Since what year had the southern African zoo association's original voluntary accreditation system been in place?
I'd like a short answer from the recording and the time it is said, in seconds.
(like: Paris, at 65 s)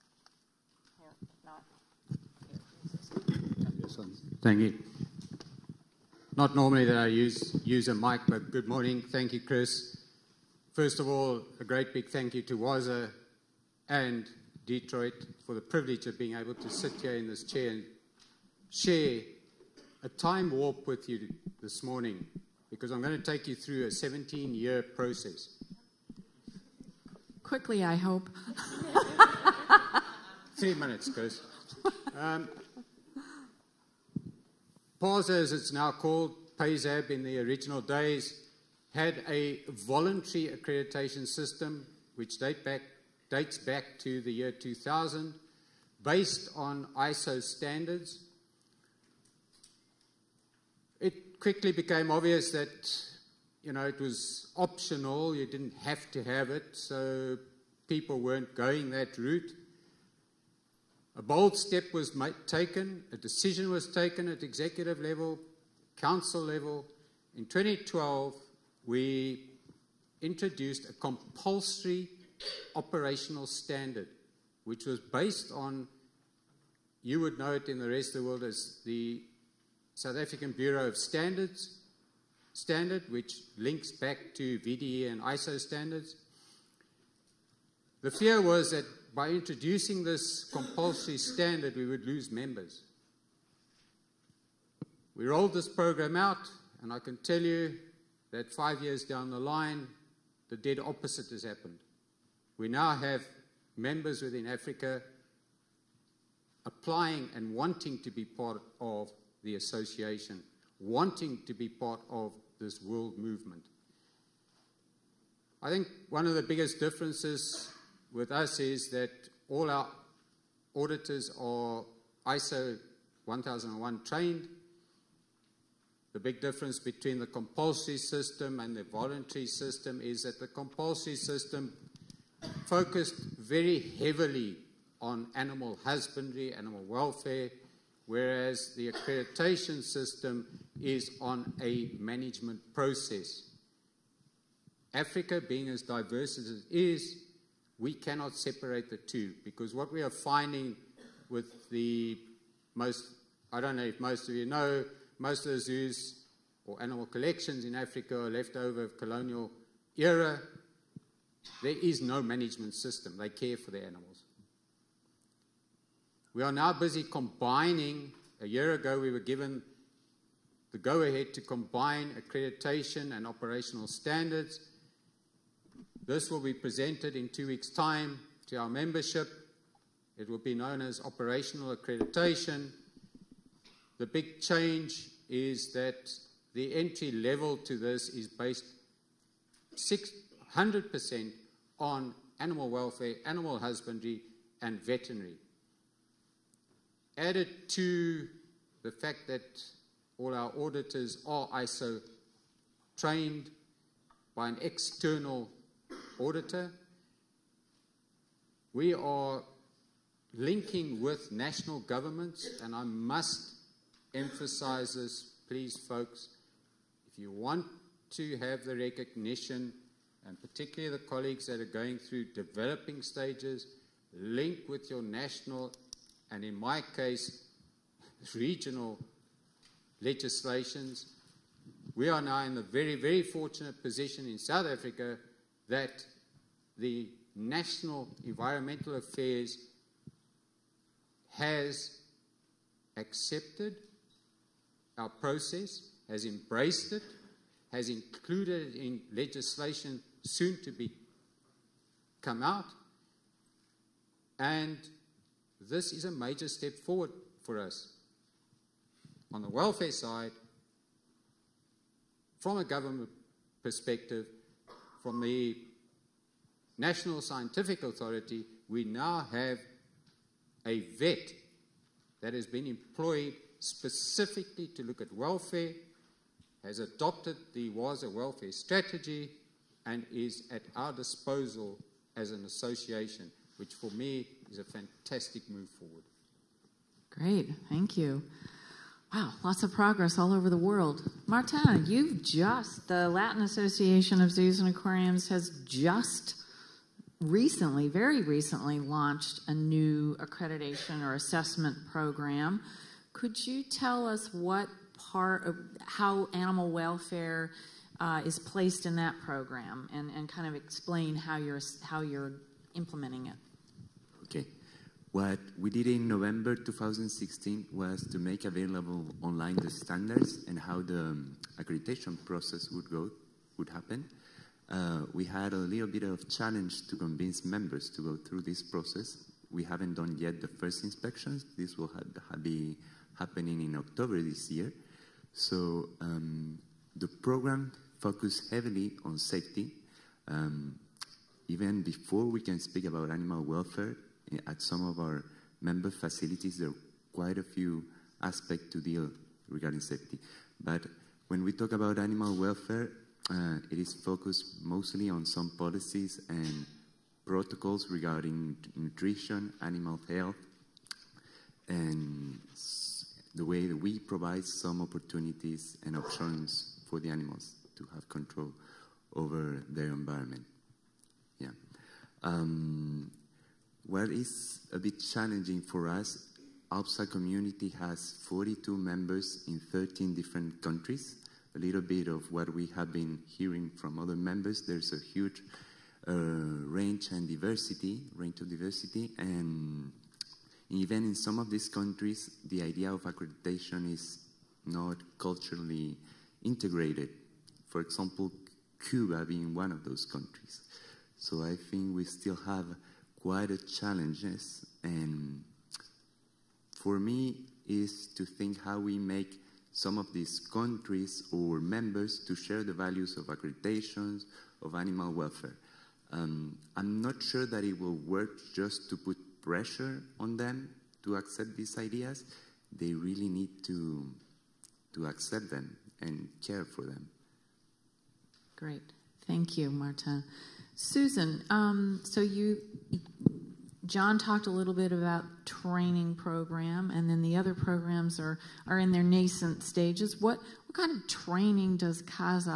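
2000, at 44 s.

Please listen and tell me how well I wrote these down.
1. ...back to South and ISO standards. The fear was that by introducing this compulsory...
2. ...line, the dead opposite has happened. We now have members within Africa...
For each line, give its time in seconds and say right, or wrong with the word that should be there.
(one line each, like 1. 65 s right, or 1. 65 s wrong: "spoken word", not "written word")
1. 83 s wrong: "VDE", not "South"
2. 99 s right.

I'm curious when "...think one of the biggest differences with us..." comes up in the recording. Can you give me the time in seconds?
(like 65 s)
115 s.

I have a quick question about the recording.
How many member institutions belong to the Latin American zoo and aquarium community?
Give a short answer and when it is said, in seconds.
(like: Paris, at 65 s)
42, at 378 s.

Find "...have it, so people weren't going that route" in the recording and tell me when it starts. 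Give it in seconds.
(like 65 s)
56 s.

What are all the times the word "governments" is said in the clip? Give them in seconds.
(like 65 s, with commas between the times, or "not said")
211 s, 262 s.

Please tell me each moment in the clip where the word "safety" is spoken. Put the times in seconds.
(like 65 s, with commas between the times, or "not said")
339 s, 349 s.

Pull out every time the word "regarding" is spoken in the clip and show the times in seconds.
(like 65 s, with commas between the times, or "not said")
349 s, 357 s.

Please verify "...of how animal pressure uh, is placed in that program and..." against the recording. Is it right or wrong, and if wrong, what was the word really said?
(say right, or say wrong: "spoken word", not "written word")
wrong: "welfare", not "pressure".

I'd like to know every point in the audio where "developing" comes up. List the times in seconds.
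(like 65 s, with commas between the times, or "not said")
222 s.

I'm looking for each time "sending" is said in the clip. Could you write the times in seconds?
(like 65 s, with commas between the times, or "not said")
not said.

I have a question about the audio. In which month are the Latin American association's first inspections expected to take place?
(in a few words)
October.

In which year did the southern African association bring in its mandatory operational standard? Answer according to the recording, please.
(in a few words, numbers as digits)
2012.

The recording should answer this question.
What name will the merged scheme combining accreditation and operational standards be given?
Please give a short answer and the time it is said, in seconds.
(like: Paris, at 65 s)
Operational accreditation, at 181 s.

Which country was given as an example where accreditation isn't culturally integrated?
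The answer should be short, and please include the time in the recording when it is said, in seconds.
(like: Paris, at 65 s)
Cuba, at 398 s.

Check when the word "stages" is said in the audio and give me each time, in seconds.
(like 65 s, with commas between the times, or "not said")
223 s, 439 s.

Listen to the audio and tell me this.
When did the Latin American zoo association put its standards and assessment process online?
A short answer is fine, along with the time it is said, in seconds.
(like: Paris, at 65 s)
November 2016, at 316 s.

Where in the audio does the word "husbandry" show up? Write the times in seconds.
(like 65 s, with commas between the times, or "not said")
135 s, 193 s.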